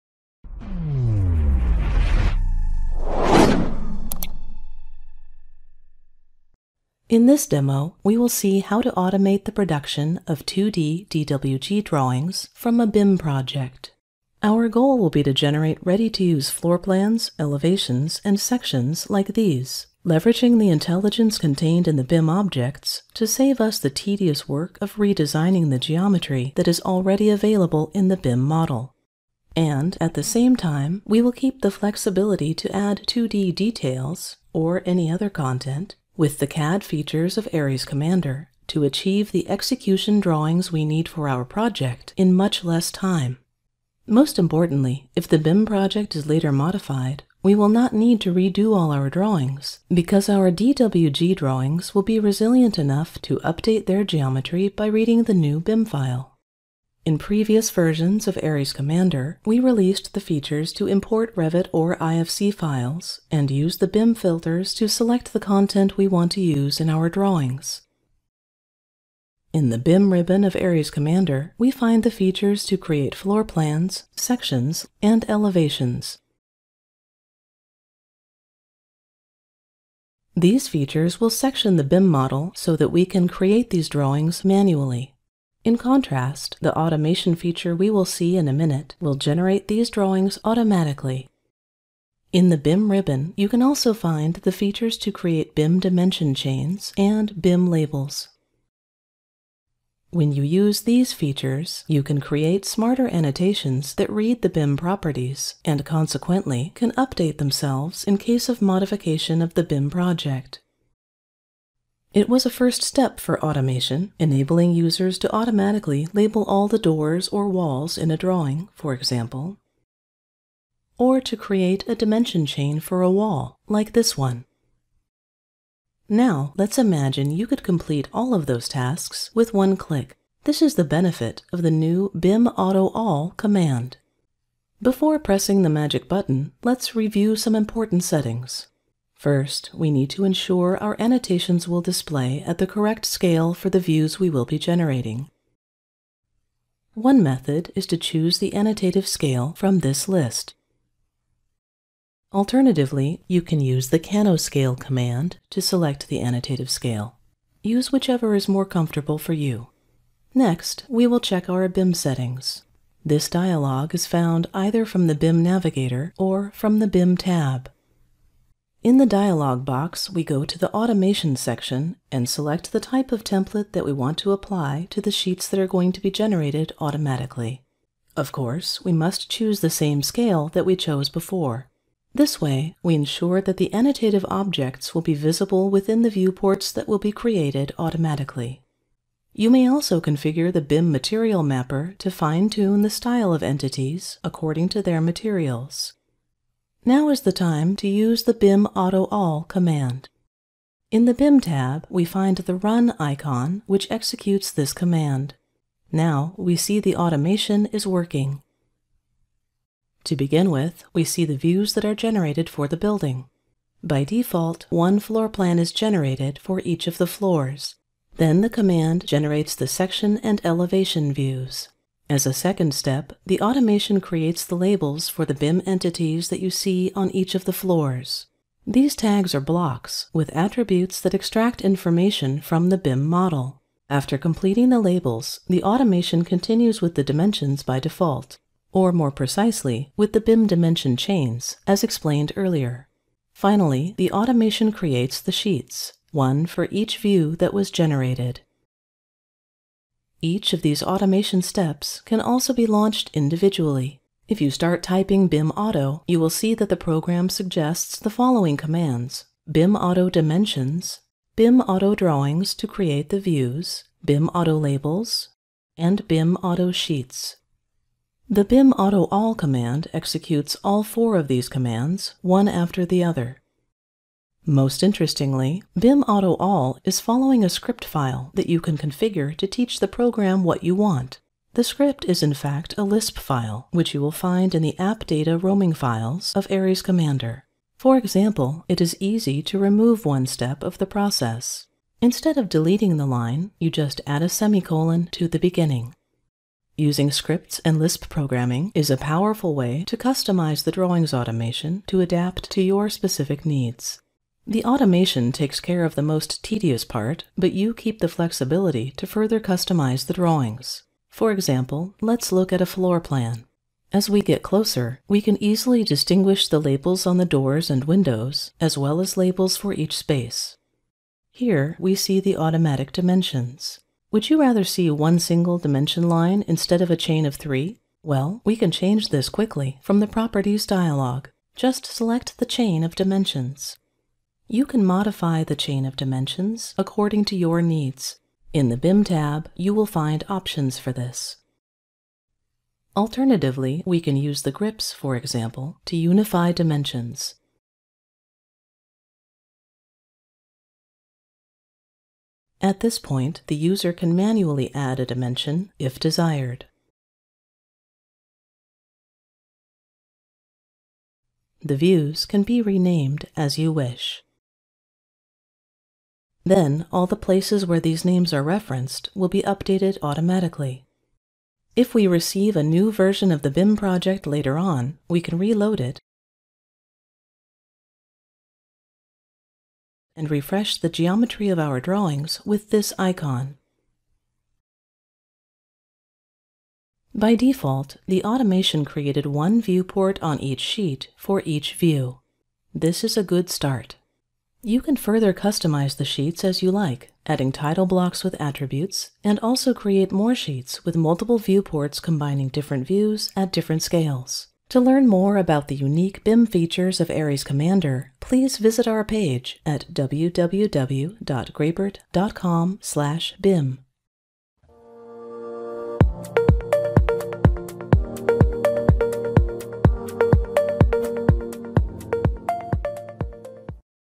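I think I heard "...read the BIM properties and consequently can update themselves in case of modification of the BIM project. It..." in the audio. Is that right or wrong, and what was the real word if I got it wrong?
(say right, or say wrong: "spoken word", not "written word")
right.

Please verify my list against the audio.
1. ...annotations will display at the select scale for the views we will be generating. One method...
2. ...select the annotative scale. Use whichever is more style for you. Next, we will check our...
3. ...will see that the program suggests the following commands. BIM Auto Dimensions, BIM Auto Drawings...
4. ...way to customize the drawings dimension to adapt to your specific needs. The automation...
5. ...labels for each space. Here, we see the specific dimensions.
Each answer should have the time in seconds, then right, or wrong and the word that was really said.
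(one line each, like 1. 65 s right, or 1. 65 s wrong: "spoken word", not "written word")
1. 140 s wrong: "correct", not "select"
2. 155 s wrong: "comfortable", not "style"
3. 256 s right
4. 299 s wrong: "automation", not "dimension"
5. 319 s wrong: "automatic", not "specific".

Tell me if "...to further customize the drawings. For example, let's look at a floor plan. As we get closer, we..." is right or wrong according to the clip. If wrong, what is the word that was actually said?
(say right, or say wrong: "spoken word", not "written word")
right.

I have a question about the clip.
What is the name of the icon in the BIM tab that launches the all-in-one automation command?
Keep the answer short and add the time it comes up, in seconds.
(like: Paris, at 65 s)
Run, at 202 s.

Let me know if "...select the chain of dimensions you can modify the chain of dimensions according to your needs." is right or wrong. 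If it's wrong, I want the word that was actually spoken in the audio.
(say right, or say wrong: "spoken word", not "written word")
right.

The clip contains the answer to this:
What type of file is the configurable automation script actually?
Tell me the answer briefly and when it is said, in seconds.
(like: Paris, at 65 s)
Lisp file, at 282 s.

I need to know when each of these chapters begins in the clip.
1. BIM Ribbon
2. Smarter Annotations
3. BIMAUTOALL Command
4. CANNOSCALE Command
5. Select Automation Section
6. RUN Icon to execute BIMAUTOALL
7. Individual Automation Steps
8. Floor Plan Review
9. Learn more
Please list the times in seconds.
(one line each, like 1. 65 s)
1. 69 s
2. 99 s
3. 125 s
4. 152 s
5. 168 s
6. 200 s
7. 250 s
8. 310 s
9. 404 s.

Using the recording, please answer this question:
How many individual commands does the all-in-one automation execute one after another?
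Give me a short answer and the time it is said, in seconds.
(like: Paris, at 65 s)
4, at 270 s.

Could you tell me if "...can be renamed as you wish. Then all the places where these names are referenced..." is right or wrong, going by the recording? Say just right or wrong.
right.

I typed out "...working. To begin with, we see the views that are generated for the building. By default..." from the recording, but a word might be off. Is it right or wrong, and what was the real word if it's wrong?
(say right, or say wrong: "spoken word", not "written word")
right.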